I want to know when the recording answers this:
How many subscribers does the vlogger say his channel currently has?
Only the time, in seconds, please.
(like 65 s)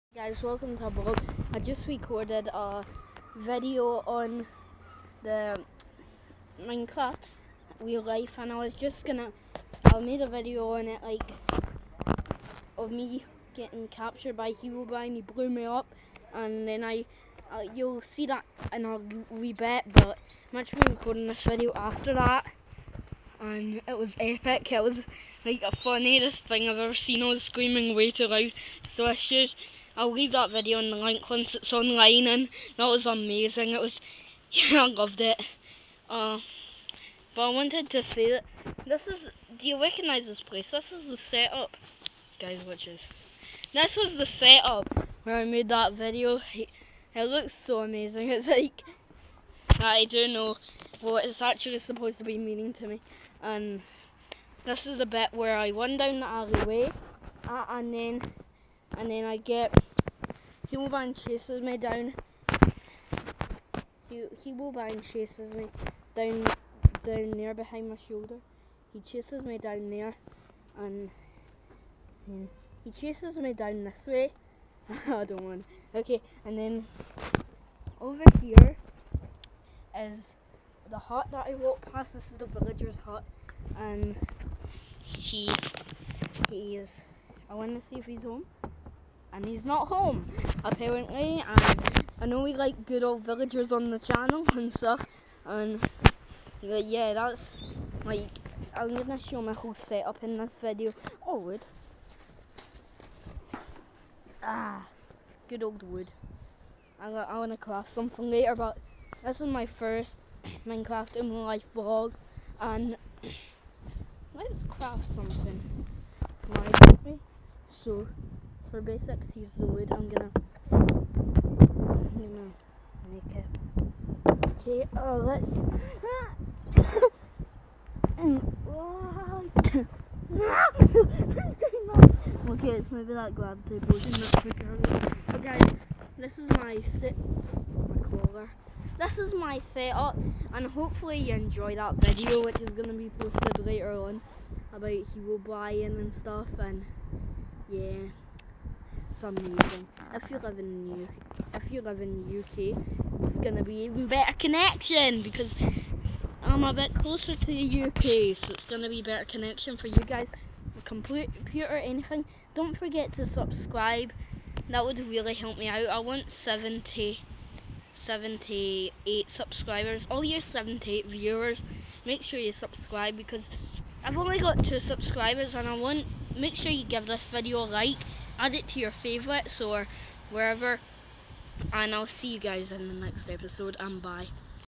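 174 s.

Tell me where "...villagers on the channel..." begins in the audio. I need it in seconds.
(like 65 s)
93 s.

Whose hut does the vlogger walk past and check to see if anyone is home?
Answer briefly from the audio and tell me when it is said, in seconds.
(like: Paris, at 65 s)
The villager, at 82 s.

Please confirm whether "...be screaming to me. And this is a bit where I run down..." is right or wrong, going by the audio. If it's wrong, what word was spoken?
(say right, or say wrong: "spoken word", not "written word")
wrong: "meaning", not "screaming".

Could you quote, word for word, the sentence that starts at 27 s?
I was screaming way too loud.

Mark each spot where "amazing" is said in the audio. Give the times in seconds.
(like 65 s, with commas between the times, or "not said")
33 s, 47 s, 149 s.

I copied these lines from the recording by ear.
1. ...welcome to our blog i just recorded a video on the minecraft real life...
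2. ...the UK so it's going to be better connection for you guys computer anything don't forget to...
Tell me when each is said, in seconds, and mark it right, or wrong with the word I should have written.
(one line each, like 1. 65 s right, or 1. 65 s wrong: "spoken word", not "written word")
1. 0 s right
2. 157 s right.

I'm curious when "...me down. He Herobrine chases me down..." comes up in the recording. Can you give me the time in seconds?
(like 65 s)
61 s.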